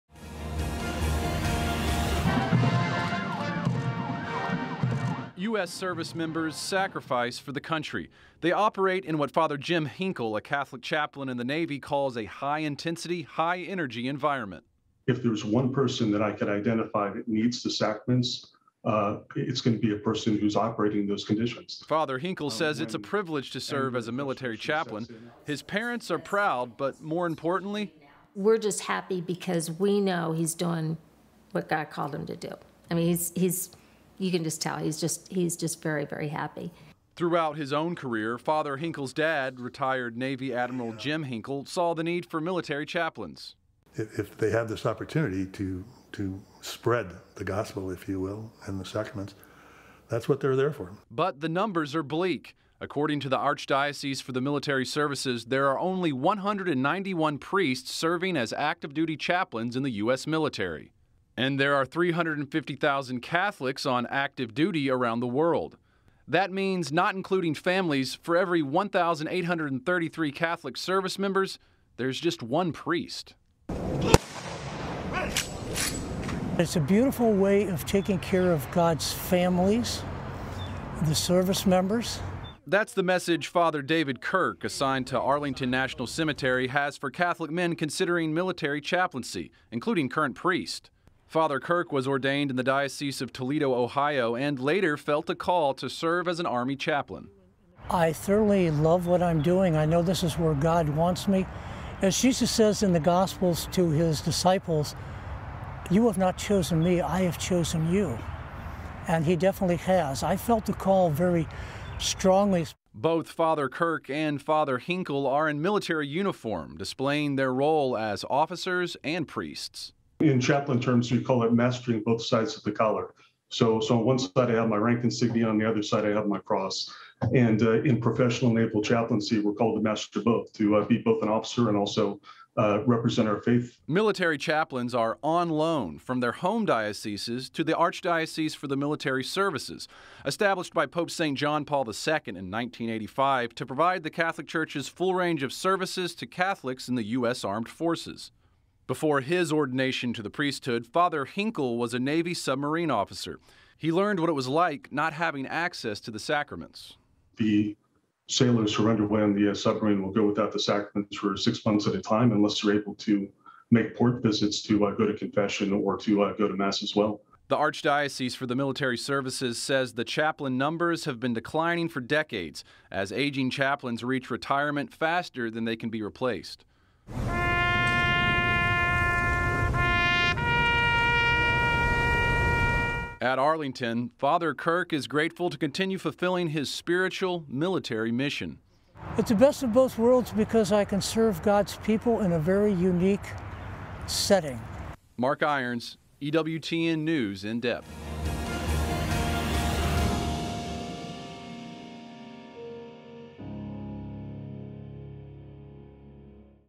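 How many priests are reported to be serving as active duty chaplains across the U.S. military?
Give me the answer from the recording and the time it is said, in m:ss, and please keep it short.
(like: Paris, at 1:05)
191, at 0:56.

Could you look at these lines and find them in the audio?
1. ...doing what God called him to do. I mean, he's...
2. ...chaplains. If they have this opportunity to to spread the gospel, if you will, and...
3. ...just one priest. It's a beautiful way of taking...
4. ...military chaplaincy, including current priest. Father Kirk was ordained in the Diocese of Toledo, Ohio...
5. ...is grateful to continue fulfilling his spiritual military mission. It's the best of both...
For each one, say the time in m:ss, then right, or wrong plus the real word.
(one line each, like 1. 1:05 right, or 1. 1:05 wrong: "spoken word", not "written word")
1. 0:30 right
2. 0:42 right
3. 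1:12 right
4. 1:28 right
5. 3:04 right.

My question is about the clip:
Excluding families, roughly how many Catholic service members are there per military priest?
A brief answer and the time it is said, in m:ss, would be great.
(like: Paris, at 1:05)
1,833, at 1:08.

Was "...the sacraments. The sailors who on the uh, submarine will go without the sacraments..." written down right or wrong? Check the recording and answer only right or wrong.
right.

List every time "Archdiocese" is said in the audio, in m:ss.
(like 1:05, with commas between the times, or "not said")
0:53, 2:17, 2:47.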